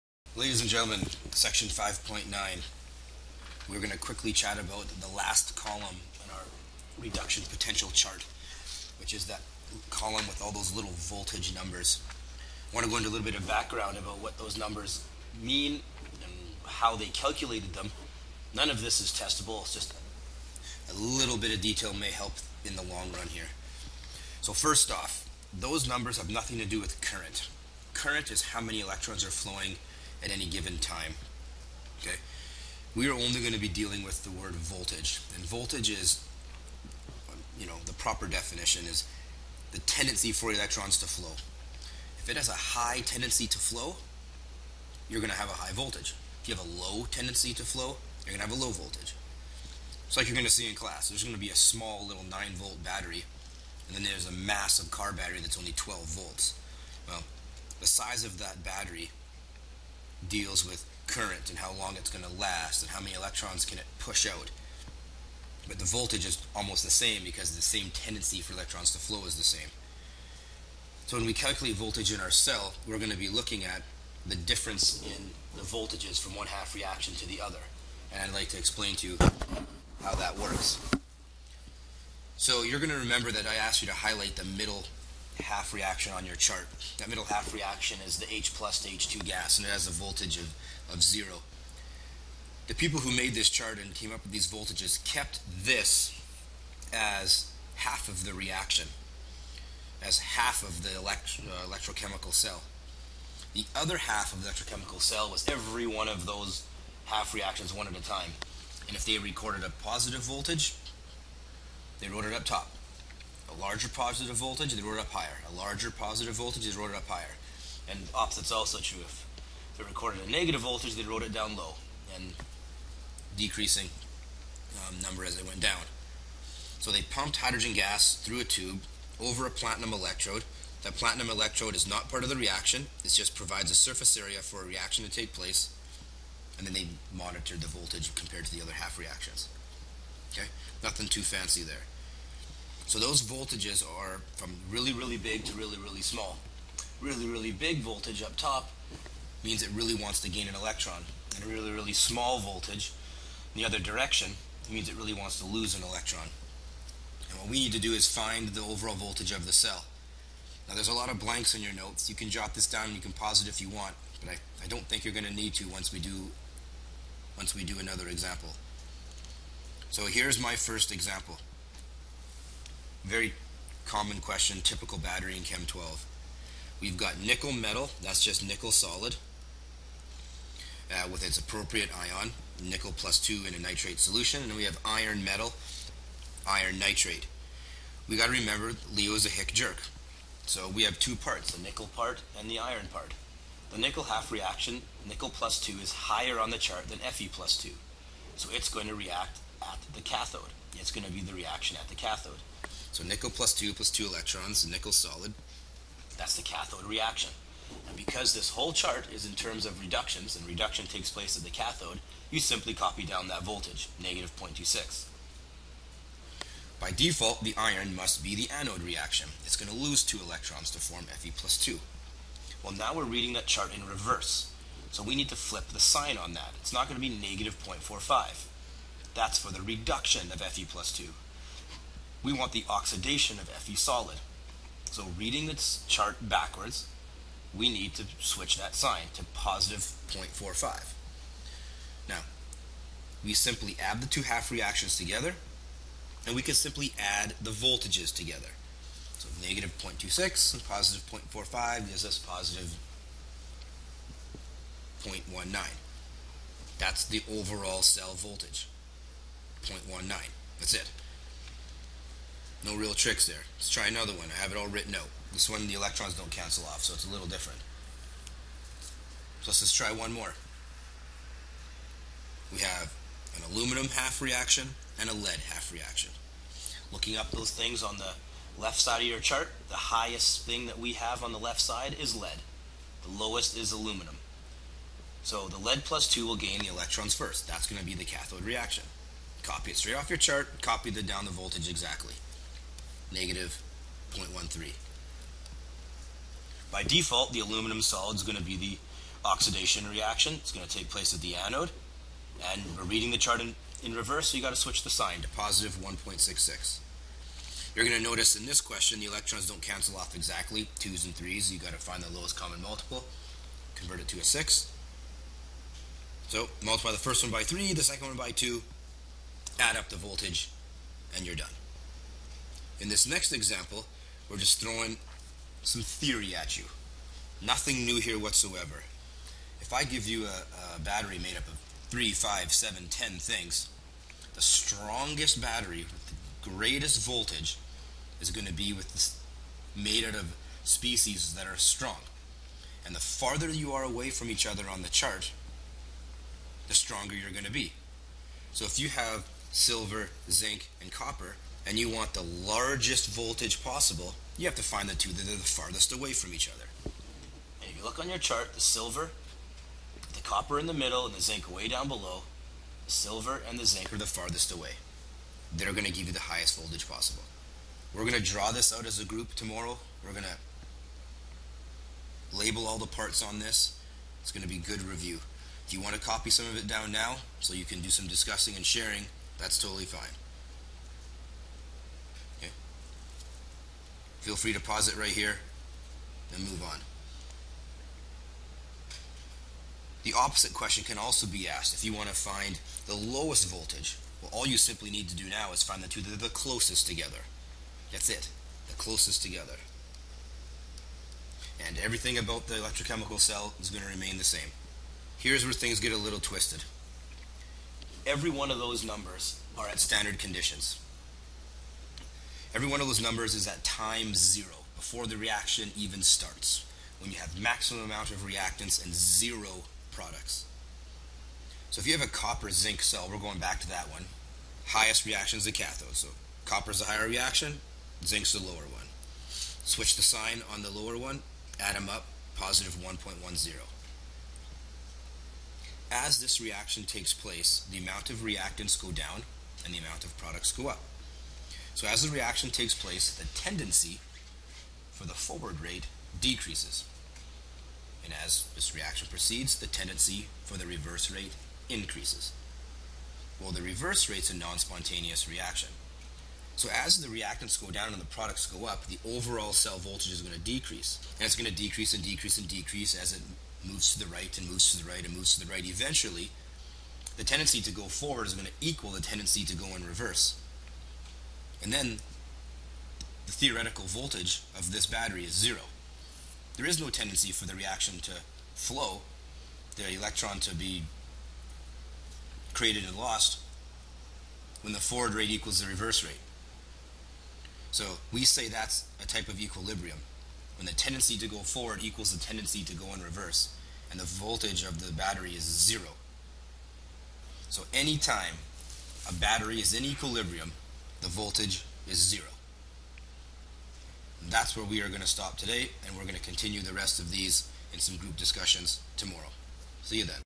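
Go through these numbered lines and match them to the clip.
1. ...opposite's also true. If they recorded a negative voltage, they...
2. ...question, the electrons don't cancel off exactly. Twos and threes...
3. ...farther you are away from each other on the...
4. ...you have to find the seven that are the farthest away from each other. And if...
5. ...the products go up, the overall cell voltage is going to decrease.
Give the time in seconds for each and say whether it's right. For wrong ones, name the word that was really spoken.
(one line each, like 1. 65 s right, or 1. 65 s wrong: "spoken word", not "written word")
1. 118 s right
2. 308 s right
3. 342 s right
4. 354 s wrong: "two", not "seven"
5. 458 s right.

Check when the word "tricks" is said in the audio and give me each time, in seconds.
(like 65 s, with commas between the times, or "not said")
262 s.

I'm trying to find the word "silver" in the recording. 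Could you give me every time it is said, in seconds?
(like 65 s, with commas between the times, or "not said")
349 s, 358 s, 362 s.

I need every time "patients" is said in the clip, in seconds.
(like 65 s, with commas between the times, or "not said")
not said.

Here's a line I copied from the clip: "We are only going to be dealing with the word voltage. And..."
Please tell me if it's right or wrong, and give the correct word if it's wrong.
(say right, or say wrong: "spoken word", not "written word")
right.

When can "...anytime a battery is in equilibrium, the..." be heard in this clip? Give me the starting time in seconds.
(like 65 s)
497 s.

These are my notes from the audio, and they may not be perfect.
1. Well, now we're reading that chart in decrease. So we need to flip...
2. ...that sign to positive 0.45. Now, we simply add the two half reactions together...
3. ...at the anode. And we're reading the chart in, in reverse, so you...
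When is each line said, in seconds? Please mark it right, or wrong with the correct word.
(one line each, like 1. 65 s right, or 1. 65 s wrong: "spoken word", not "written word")
1. 222 s wrong: "reverse", not "decrease"
2. 238 s right
3. 301 s right.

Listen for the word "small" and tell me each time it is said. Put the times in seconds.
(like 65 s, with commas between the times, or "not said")
51 s, 146 s, 151 s.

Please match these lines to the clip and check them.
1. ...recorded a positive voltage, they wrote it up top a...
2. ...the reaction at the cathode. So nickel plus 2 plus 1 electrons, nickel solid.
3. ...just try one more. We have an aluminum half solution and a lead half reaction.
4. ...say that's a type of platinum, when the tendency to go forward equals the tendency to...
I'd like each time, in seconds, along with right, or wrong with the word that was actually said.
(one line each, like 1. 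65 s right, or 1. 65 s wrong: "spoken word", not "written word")
1. 109 s right
2. 201 s wrong: "2", not "1"
3. 269 s wrong: "reaction", not "solution"
4. 488 s wrong: "equilibrium", not "platinum".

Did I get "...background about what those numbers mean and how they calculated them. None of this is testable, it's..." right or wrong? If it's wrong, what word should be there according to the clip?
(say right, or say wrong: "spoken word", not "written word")
right.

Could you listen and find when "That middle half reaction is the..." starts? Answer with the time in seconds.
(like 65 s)
86 s.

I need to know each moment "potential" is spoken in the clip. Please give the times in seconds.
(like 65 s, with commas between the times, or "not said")
7 s.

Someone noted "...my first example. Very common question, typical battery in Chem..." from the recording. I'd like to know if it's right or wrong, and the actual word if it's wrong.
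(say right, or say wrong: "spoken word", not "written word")
right.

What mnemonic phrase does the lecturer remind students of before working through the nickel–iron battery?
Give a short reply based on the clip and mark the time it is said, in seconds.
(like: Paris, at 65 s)
Leo's a Hick jerk, at 188 s.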